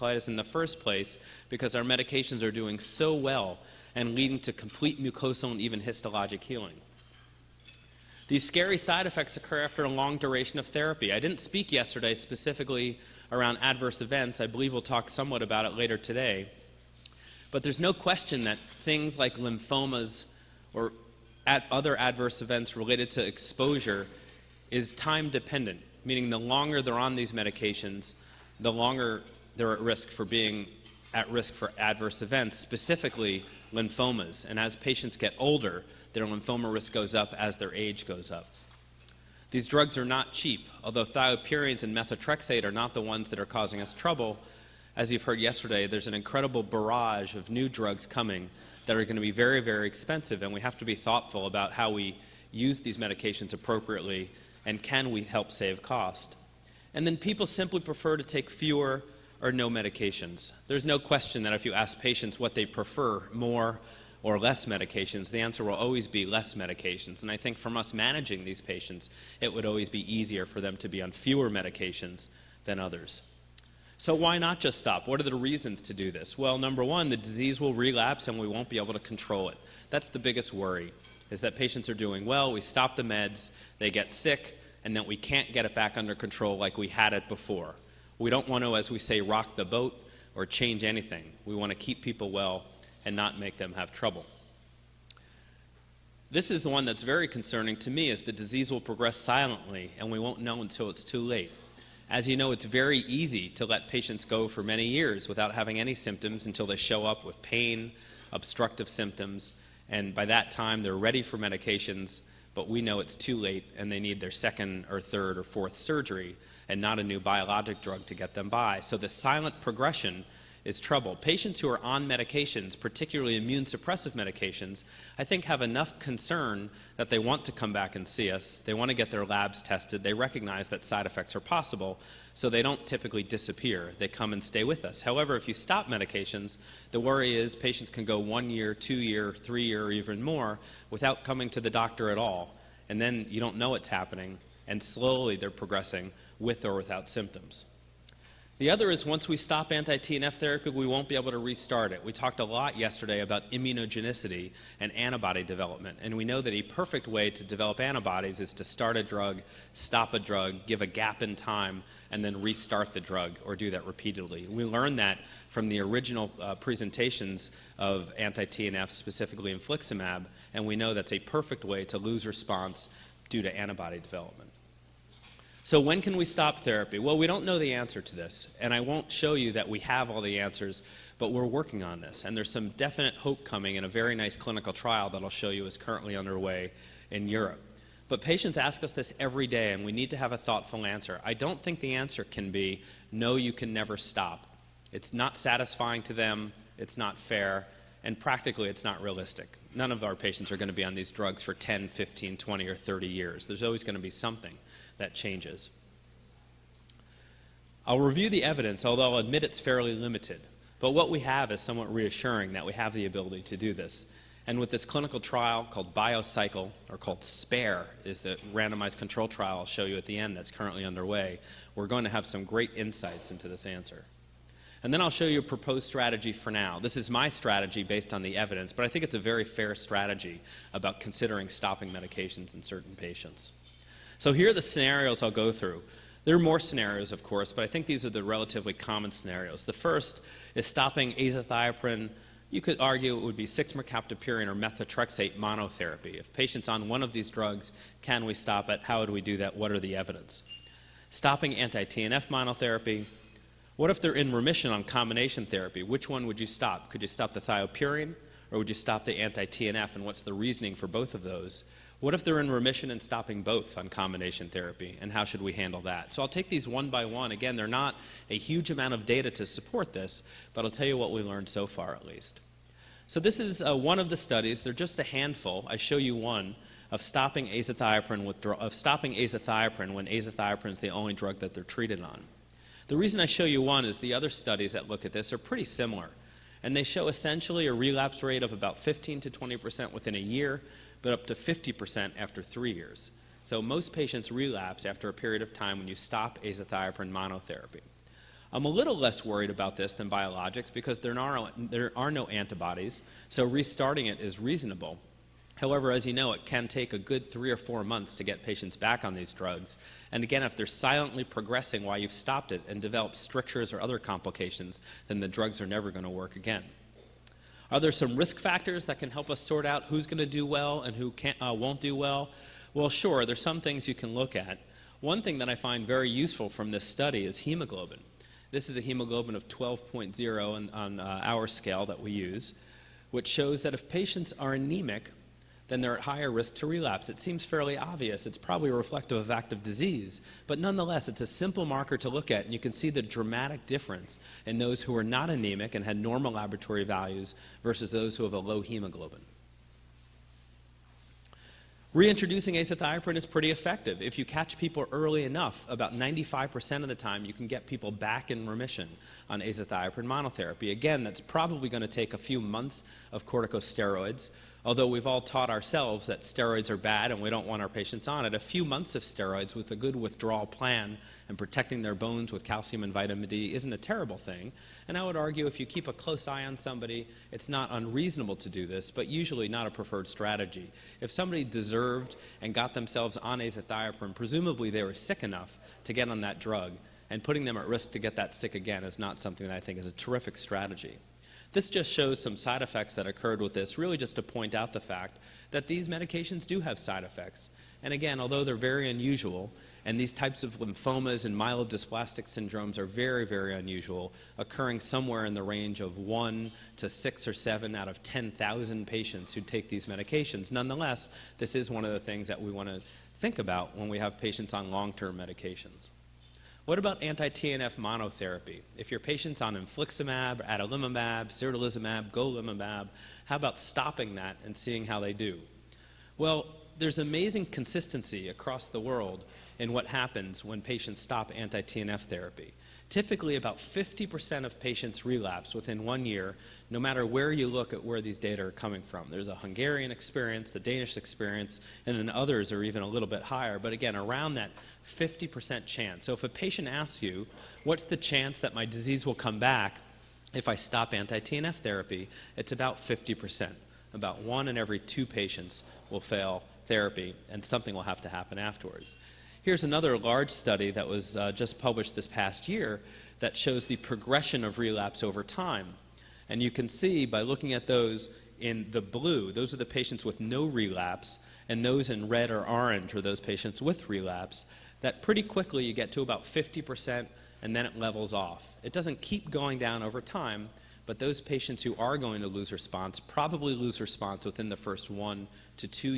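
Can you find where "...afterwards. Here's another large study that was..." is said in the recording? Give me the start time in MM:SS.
07:38.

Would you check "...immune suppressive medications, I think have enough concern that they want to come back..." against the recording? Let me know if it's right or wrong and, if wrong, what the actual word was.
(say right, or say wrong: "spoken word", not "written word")
right.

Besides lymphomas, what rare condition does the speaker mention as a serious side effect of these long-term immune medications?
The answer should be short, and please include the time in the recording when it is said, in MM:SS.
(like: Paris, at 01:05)
myelodysplastic syndromes, at 06:41.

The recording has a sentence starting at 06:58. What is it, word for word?
If your patient's on infliximab, adalimumab, certolizumab, golimumab, how about stopping that and seeing how they do?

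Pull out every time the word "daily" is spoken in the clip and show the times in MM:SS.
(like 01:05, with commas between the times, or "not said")
not said.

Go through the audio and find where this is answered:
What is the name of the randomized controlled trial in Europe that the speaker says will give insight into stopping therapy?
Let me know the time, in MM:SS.
03:37.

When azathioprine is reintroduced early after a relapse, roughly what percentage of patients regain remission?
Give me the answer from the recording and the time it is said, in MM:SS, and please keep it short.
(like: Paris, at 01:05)
95%, at 05:55.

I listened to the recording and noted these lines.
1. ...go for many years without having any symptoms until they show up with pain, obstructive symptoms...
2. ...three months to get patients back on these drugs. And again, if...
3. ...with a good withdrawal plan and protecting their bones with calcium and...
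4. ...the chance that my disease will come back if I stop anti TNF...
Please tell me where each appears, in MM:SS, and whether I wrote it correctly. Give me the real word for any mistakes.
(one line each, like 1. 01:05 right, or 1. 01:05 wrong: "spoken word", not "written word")
1. 01:44 right
2. 05:07 wrong: "four", not "three"
3. 06:09 right
4. 07:27 right.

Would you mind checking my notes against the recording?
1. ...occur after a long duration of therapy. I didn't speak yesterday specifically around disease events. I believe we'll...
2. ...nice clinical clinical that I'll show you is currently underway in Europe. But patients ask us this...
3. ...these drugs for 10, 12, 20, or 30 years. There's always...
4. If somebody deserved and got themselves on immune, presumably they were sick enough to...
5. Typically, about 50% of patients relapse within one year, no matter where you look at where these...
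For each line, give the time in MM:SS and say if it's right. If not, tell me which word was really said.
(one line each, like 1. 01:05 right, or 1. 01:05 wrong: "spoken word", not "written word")
1. 00:09 wrong: "adverse", not "disease"
2. 03:04 wrong: "trial", not "clinical"
3. 03:20 wrong: "15", not "12"
4. 06:21 wrong: "azathioprine", not "immune"
5. 07:12 right.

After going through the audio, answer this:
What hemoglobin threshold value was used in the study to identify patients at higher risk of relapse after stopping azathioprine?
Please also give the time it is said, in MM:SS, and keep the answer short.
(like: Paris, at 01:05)
12.0, at 05:29.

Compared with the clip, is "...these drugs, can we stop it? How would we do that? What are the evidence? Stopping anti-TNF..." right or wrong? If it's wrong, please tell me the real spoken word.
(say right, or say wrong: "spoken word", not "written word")
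right.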